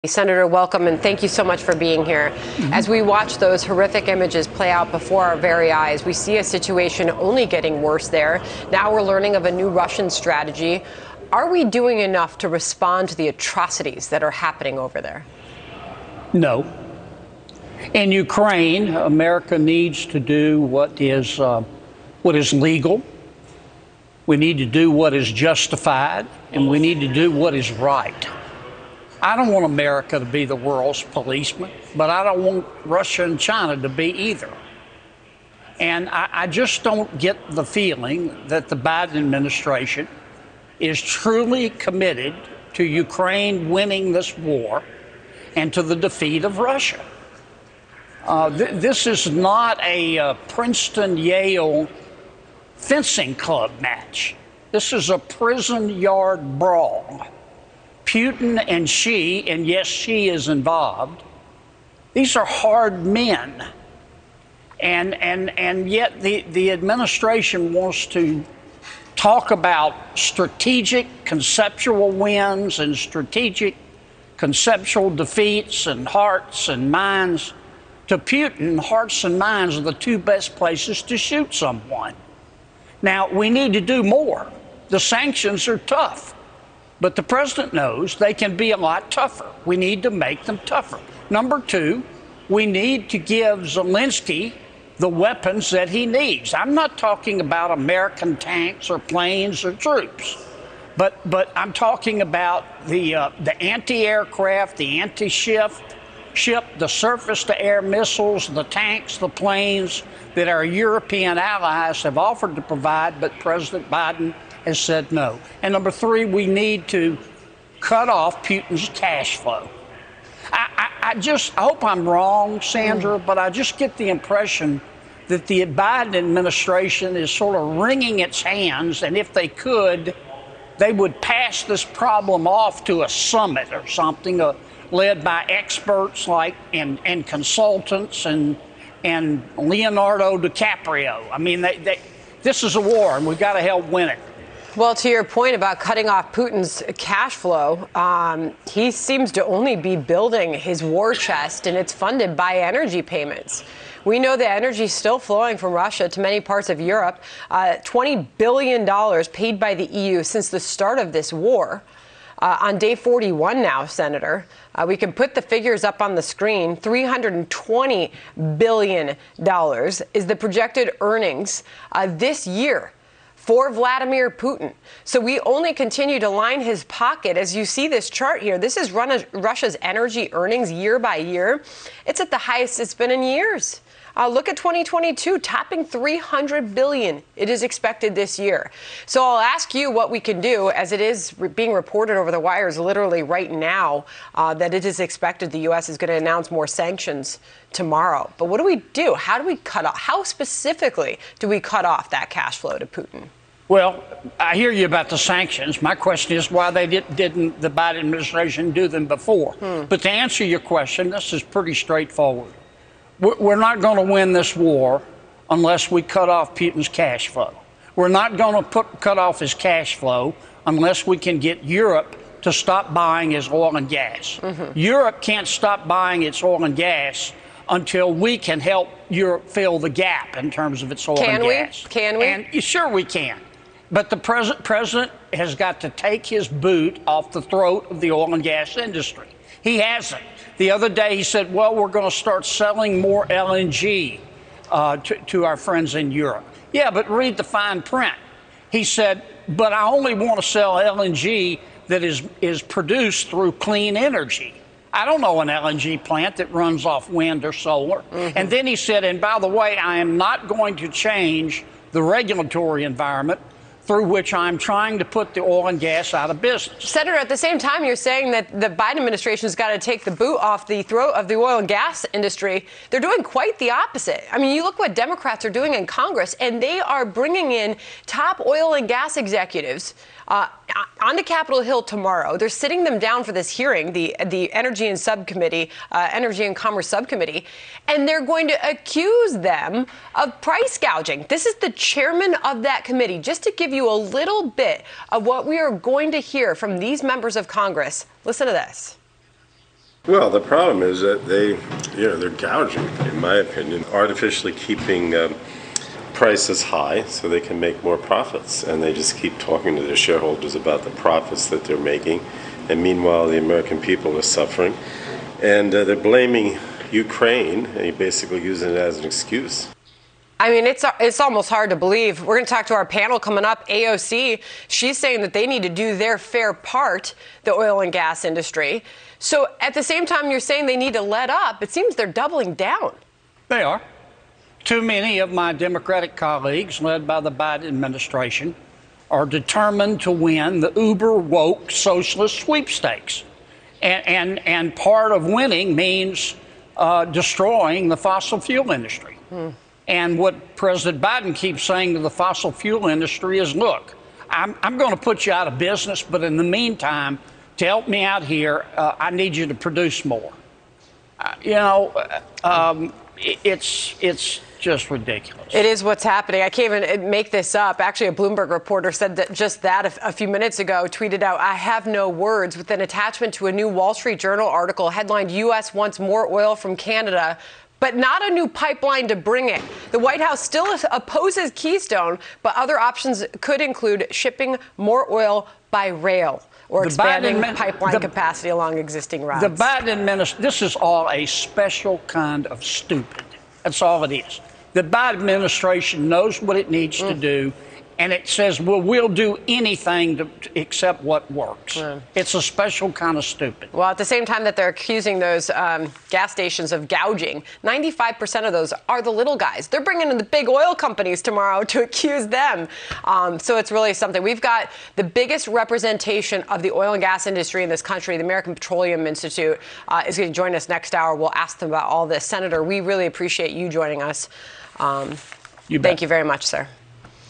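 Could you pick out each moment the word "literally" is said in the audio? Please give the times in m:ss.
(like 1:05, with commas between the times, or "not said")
3:12.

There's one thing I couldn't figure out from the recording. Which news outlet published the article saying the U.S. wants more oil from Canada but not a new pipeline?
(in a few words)
Wall Street Journal.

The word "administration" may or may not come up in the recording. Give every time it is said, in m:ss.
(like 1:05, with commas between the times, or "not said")
0:39, 1:06, 2:06, 3:27, 4:28, 5:37, 6:29, 6:35.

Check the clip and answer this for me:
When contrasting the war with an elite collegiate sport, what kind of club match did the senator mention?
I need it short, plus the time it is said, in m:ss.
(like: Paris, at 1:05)
Princeton Yale fencing club match, at 0:50.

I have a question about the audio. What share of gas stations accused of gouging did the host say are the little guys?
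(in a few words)
95%.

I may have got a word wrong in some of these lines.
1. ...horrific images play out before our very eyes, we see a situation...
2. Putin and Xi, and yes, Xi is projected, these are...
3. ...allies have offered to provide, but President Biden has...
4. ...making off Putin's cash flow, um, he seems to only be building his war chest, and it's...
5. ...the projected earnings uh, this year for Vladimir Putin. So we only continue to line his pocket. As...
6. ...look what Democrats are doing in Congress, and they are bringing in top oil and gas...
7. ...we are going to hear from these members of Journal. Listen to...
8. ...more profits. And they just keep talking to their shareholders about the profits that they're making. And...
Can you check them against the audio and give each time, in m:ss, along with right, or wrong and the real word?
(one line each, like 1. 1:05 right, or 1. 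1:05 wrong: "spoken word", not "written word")
1. 0:03 right
2. 0:58 wrong: "involved", not "projected"
3. 1:51 right
4. 2:25 wrong: "cutting", not "making"
5. 2:50 right
6. 4:34 right
7. 4:55 wrong: "Congress", not "Journal"
8. 5:07 right.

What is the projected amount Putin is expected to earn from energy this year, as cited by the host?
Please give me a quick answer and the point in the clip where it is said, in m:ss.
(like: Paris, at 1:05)
$320 billion, at 2:46.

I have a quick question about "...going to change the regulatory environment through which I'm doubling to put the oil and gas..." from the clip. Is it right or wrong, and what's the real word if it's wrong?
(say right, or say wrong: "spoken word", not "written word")
wrong: "trying", not "doubling".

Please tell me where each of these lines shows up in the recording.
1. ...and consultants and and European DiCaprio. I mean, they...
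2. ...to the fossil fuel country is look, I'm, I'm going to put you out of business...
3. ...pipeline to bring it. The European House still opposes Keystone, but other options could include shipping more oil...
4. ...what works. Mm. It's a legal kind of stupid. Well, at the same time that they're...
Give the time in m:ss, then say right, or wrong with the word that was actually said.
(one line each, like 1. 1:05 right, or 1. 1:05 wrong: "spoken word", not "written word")
1. 2:17 wrong: "Leonardo", not "European"
2. 5:51 wrong: "industry", not "country"
3. 6:18 wrong: "White", not "European"
4. 6:41 wrong: "special", not "legal".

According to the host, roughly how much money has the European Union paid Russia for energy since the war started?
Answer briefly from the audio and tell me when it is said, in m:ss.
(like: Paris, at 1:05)
$20 billion, at 2:37.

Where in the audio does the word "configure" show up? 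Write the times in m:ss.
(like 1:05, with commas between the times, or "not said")
not said.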